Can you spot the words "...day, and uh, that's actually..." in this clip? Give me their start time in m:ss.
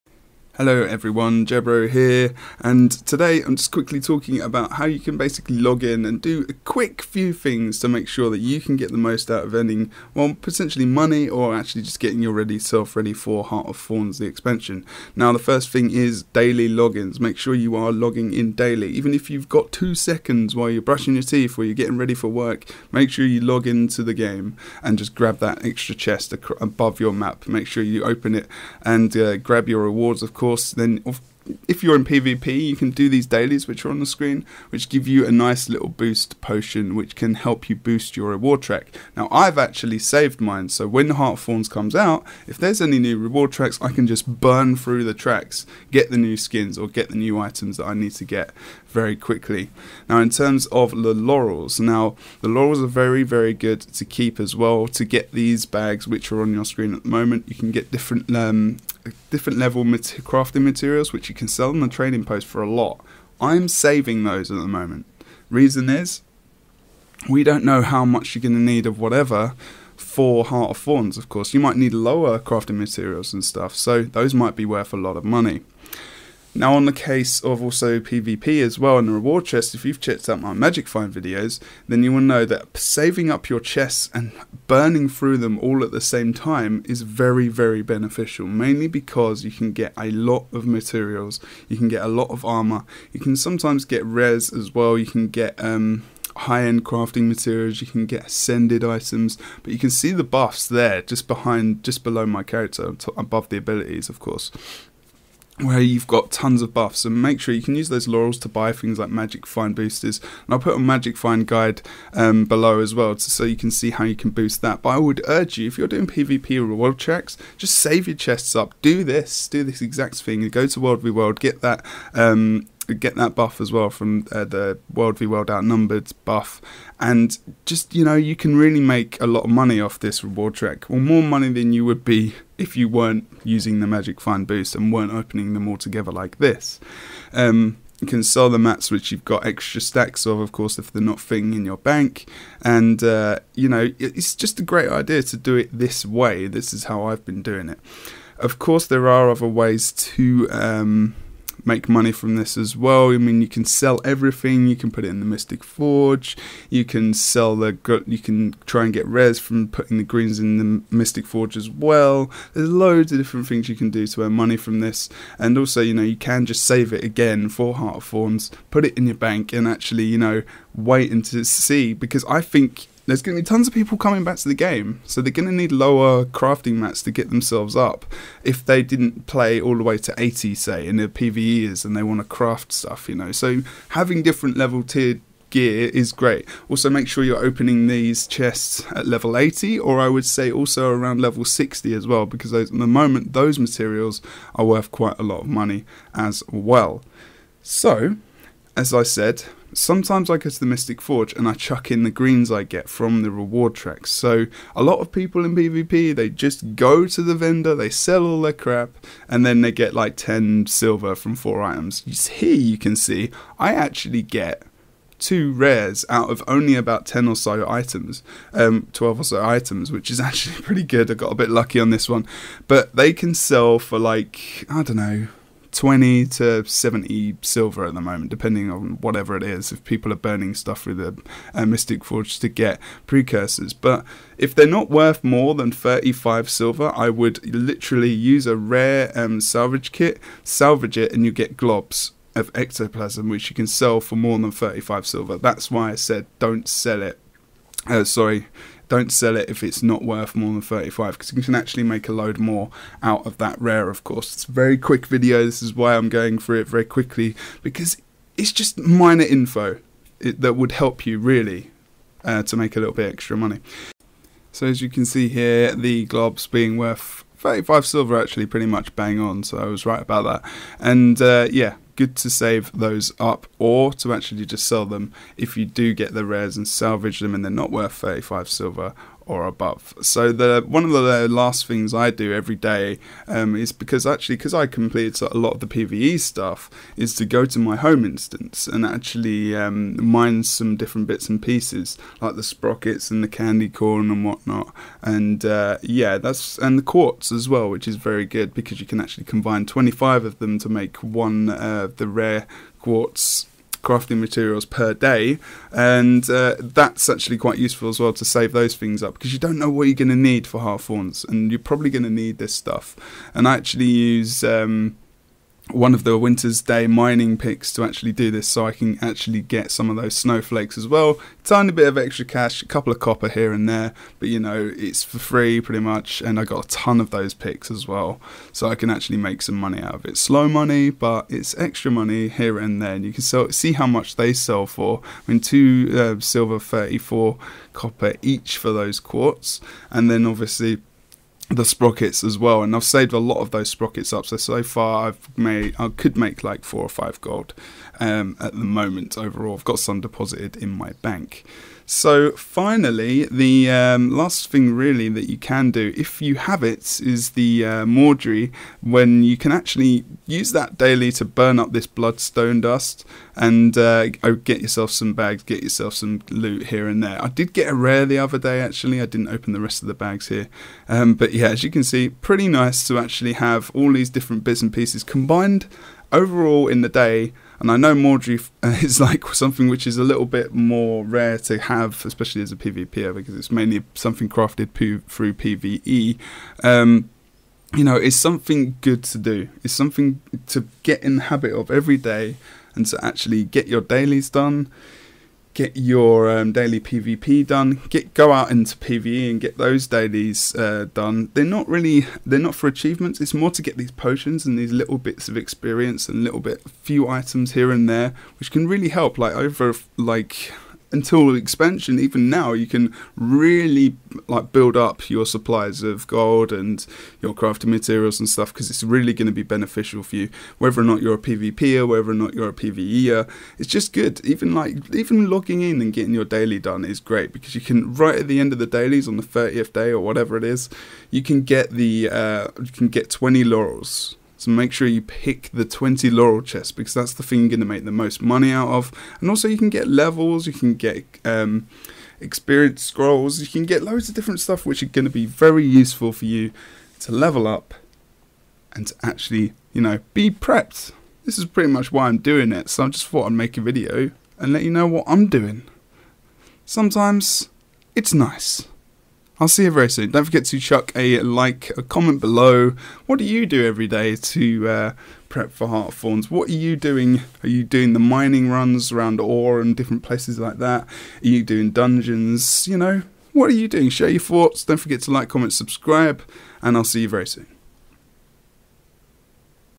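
5:04.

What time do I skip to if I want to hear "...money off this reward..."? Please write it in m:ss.
2:09.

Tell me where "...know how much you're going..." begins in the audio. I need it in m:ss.
1:07.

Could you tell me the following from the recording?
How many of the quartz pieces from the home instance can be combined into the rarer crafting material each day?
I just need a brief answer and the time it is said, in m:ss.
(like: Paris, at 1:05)
25, at 4:59.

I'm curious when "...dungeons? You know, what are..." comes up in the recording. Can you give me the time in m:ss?
7:51.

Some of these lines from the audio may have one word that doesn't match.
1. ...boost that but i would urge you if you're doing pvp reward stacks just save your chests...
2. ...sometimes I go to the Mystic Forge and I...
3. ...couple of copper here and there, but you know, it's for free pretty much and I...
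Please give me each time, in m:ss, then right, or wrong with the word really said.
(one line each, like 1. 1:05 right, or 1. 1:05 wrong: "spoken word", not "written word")
1. 1:54 wrong: "checks", not "stacks"
2. 3:19 right
3. 5:22 right.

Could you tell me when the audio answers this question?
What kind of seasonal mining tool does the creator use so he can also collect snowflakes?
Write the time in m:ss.
5:16.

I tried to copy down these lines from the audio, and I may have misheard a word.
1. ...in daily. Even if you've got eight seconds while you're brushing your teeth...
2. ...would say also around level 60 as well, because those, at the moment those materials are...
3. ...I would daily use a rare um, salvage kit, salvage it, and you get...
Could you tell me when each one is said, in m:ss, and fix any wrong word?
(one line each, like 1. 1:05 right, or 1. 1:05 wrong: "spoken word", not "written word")
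1. 0:18 wrong: "two", not "eight"
2. 3:10 right
3. 3:56 wrong: "literally", not "daily".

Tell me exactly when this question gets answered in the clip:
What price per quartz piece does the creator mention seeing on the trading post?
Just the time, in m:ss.
5:35.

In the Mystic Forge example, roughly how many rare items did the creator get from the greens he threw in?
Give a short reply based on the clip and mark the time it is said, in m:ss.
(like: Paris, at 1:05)
2, at 3:35.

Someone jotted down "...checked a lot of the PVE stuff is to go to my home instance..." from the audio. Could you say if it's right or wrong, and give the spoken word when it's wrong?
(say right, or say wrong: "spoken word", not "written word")
wrong: "completed", not "checked".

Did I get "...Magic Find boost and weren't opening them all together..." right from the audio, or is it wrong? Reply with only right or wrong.
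right.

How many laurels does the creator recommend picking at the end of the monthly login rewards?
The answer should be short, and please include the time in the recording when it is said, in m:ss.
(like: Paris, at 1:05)
20, at 7:13.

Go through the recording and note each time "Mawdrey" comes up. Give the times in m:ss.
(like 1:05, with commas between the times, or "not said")
5:57, 6:17.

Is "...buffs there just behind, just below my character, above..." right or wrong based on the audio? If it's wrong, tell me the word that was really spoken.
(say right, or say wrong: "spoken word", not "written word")
right.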